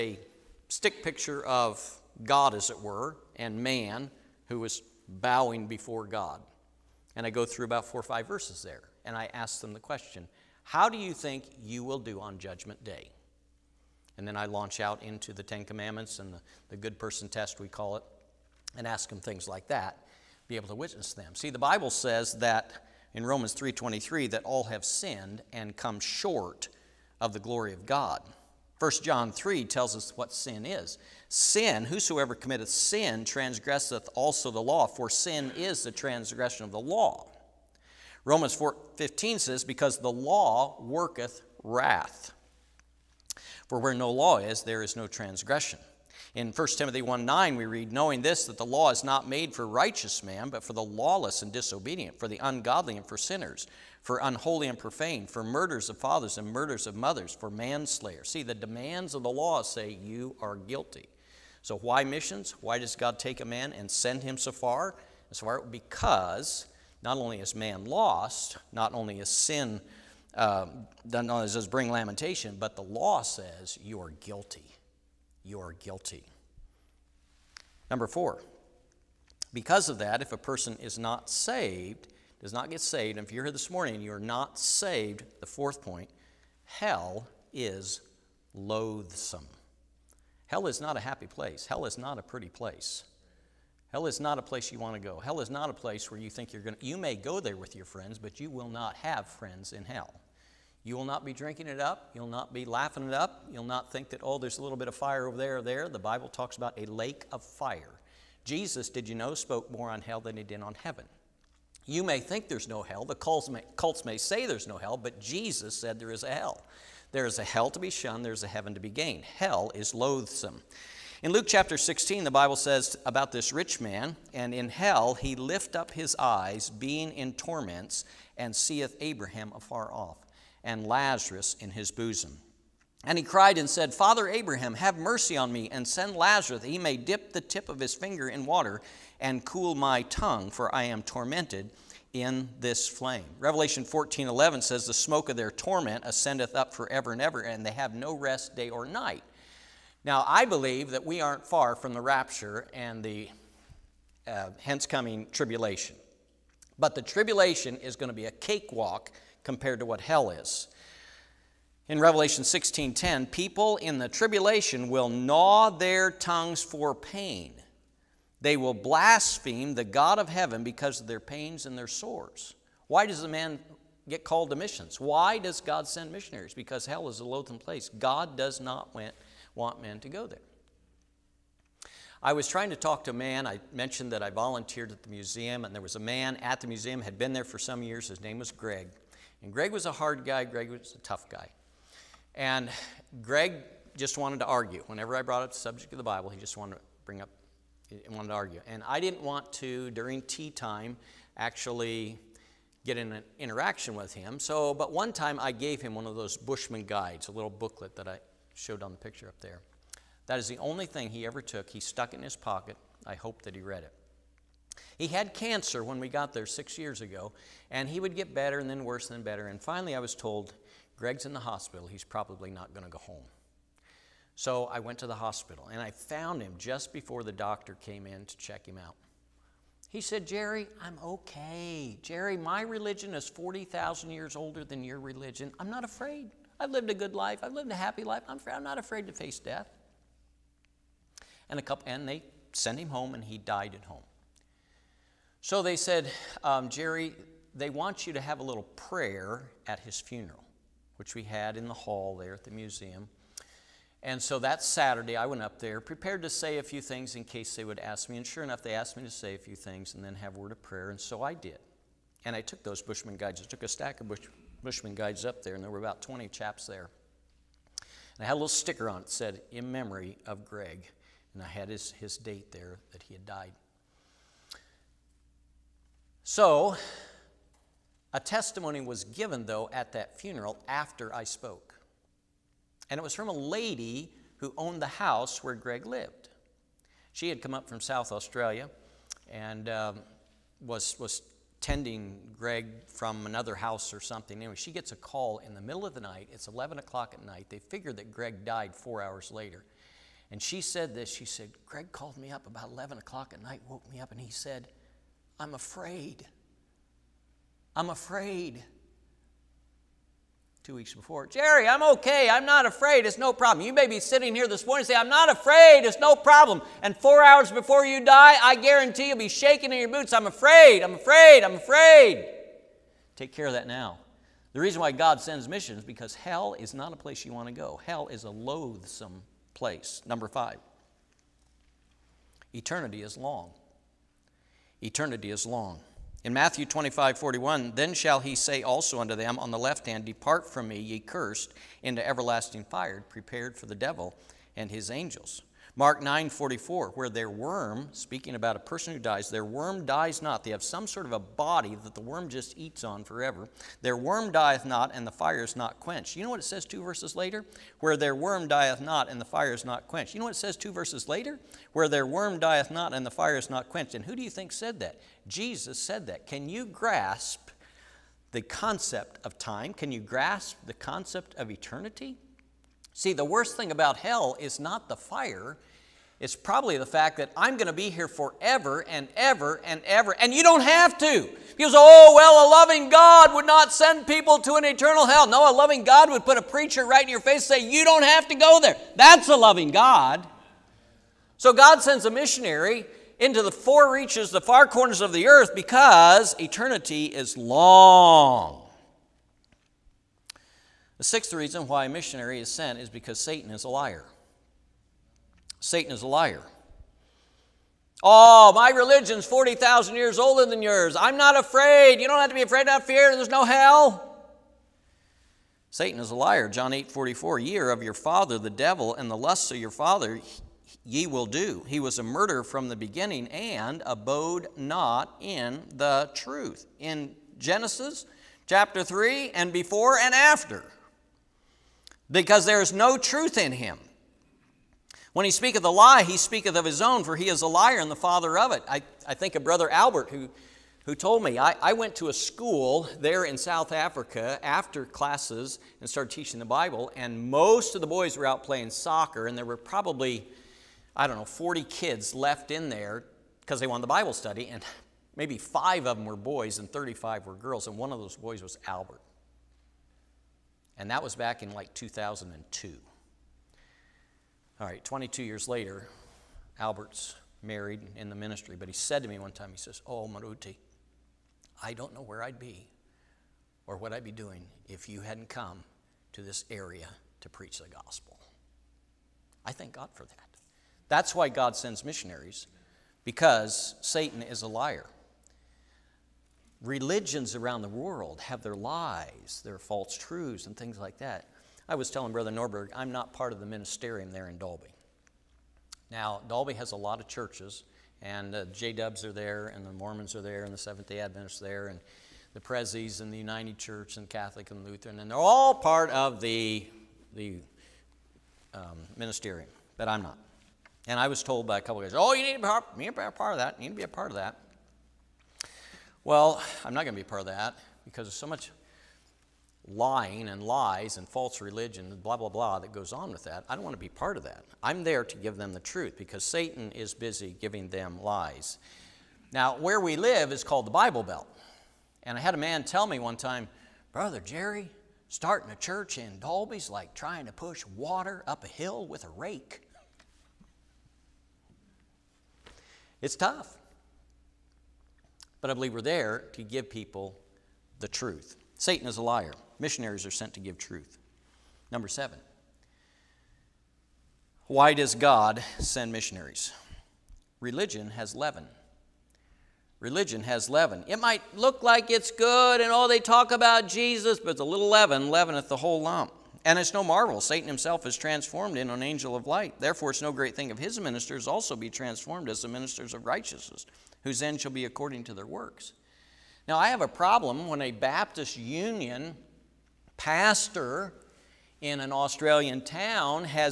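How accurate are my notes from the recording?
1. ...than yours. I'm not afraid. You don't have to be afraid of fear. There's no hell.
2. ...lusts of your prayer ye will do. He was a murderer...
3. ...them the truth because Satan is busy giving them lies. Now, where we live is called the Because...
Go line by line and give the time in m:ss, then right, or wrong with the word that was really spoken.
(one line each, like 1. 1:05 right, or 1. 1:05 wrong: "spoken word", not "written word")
1. 6:50 right
2. 6:59 wrong: "father", not "prayer"
3. 8:45 wrong: "Bible", not "Because".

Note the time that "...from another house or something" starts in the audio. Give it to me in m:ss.
4:52.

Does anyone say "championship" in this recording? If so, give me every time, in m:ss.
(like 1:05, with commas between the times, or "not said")
not said.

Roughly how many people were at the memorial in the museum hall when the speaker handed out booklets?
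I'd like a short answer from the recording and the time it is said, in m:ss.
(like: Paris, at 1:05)
about 20, at 4:25.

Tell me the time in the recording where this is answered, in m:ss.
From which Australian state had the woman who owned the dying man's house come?
4:47.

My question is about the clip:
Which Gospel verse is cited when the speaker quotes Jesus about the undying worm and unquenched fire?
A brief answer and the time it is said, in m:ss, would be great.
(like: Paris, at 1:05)
Mark 9:44, at 5:45.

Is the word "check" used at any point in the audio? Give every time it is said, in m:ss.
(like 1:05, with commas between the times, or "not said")
3:48.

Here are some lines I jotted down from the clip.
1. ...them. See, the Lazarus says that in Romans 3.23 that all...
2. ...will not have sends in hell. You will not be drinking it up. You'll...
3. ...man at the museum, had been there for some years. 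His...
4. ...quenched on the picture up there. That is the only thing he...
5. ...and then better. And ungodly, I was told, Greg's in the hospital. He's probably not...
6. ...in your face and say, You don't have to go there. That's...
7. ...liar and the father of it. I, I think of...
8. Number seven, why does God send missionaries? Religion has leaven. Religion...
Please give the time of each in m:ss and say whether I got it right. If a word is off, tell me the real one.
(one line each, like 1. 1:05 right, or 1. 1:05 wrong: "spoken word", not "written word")
1. 0:21 wrong: "Bible", not "Lazarus"
2. 1:38 wrong: "friends", not "sends"
3. 3:05 right
4. 3:28 wrong: "showed", not "quenched"
5. 3:39 wrong: "finally", not "ungodly"
6. 6:27 right
7. 7:17 right
8. 9:11 right.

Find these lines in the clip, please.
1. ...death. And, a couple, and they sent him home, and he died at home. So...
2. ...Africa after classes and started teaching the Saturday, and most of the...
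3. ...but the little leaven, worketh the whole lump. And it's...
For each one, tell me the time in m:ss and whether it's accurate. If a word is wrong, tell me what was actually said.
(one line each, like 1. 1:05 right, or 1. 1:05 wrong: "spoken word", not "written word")
1. 3:59 right
2. 7:23 wrong: "Bible", not "Saturday"
3. 9:24 wrong: "leaveneth", not "worketh".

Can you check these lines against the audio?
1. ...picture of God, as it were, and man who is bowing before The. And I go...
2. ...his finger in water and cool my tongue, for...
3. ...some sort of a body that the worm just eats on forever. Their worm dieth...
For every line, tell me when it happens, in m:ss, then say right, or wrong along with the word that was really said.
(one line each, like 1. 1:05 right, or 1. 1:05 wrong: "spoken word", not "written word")
1. 0:01 wrong: "God", not "The"
2. 2:17 right
3. 5:50 right.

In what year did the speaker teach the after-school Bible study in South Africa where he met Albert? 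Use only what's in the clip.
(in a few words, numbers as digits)
2002.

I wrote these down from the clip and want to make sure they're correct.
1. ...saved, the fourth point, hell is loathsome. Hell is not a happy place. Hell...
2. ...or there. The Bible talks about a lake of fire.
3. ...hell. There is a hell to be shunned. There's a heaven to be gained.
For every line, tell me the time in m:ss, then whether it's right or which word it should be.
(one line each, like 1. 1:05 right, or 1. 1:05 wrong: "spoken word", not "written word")
1. 1:24 right
2. 1:45 right
3. 1:56 right.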